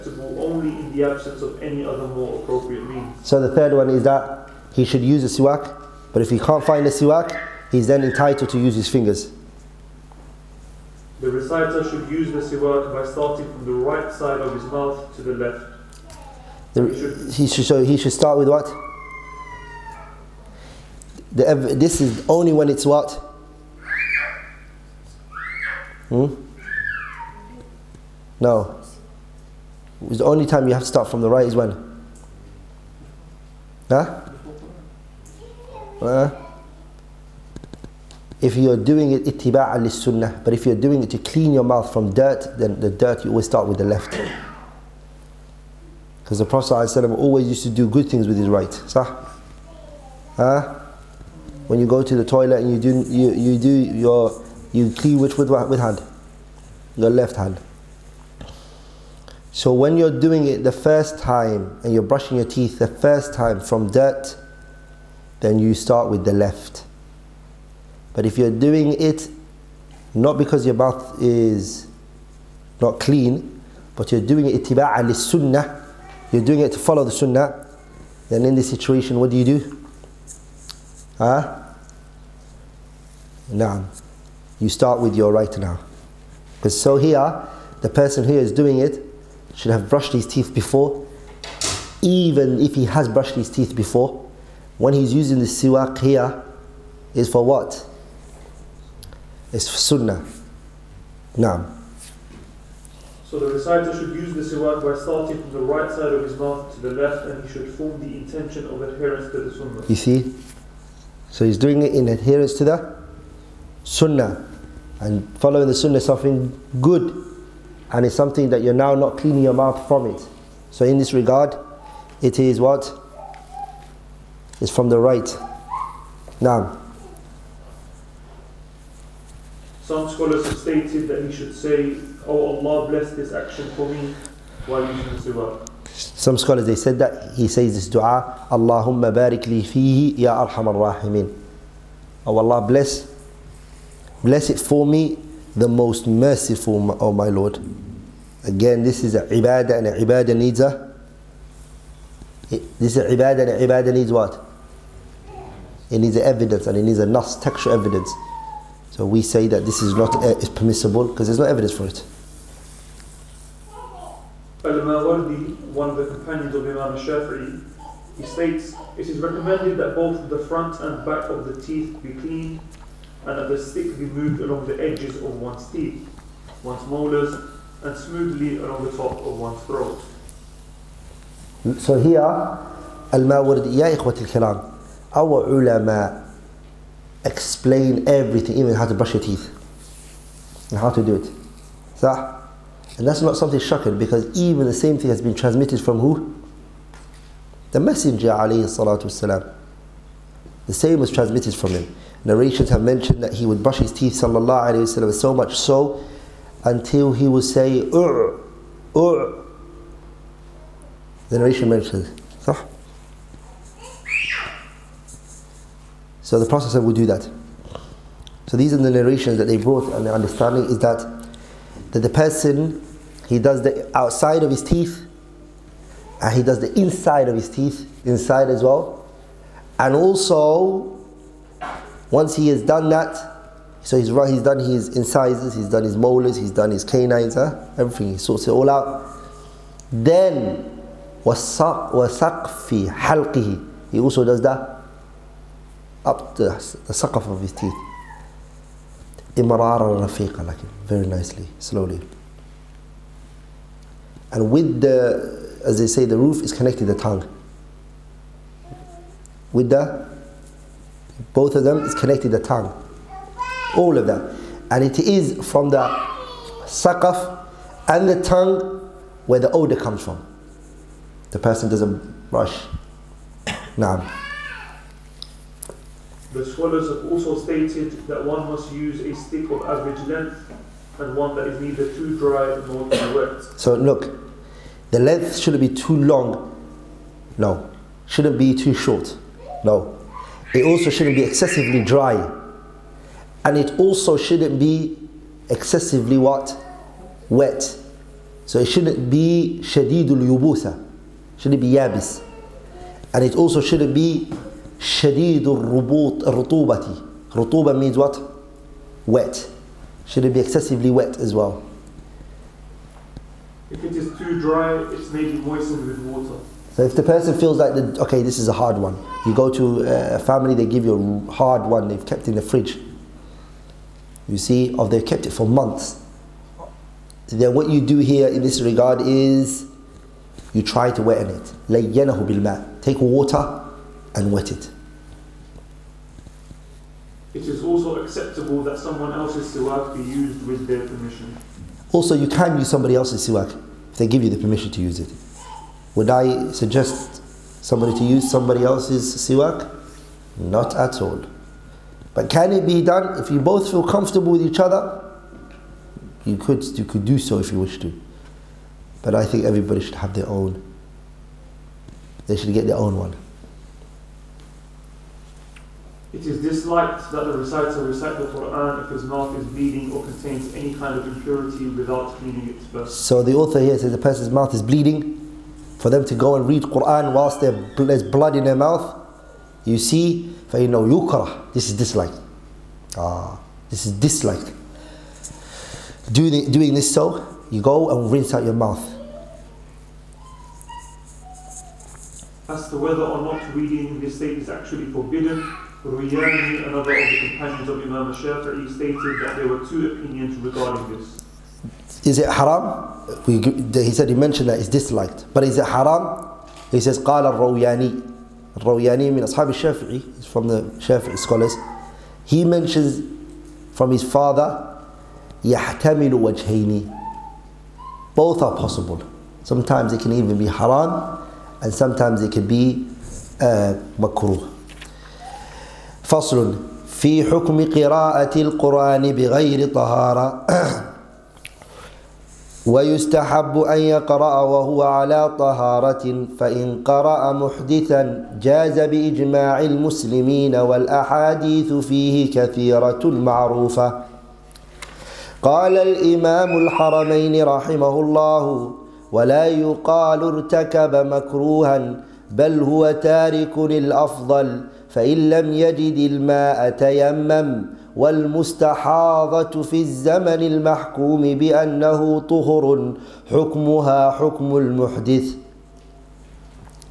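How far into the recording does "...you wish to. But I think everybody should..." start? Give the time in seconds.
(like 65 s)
357 s.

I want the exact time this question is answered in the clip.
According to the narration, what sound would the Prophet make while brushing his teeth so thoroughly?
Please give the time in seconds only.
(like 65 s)
207 s.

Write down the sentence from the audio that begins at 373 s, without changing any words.
So the author here says the person's mouth is bleeding.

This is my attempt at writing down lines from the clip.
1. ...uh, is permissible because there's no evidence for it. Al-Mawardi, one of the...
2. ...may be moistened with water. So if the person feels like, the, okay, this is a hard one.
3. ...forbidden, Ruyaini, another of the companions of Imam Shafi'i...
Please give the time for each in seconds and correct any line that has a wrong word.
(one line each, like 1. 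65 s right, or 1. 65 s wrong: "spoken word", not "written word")
1. 160 s right
2. 315 s right
3. 394 s right.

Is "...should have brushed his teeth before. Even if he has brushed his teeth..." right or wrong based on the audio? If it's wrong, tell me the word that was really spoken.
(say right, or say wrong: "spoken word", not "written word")
right.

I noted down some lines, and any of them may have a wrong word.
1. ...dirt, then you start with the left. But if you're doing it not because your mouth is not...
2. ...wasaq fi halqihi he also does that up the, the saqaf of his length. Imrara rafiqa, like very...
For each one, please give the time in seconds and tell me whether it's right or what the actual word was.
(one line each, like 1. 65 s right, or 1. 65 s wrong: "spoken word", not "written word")
1. 63 s right
2. 241 s wrong: "teeth", not "length".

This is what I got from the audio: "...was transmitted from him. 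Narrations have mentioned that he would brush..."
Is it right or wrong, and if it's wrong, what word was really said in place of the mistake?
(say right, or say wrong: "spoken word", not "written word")
right.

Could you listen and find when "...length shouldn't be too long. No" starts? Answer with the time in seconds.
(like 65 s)
284 s.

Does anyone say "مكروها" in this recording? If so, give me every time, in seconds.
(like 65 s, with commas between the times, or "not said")
450 s.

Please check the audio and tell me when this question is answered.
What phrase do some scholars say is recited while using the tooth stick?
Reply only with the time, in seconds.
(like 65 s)
138 s.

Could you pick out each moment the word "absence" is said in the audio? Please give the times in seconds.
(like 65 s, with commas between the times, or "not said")
1 s.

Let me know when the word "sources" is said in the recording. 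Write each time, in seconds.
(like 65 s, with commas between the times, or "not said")
not said.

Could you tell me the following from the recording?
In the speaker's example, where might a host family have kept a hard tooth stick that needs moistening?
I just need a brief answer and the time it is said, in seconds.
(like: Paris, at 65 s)
In the fridge, at 321 s.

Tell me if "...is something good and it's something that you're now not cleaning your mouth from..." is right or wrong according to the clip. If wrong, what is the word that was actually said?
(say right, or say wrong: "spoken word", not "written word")
right.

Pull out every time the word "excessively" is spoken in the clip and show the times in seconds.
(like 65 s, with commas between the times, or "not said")
291 s, 295 s, 310 s.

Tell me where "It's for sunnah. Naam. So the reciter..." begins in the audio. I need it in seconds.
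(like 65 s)
99 s.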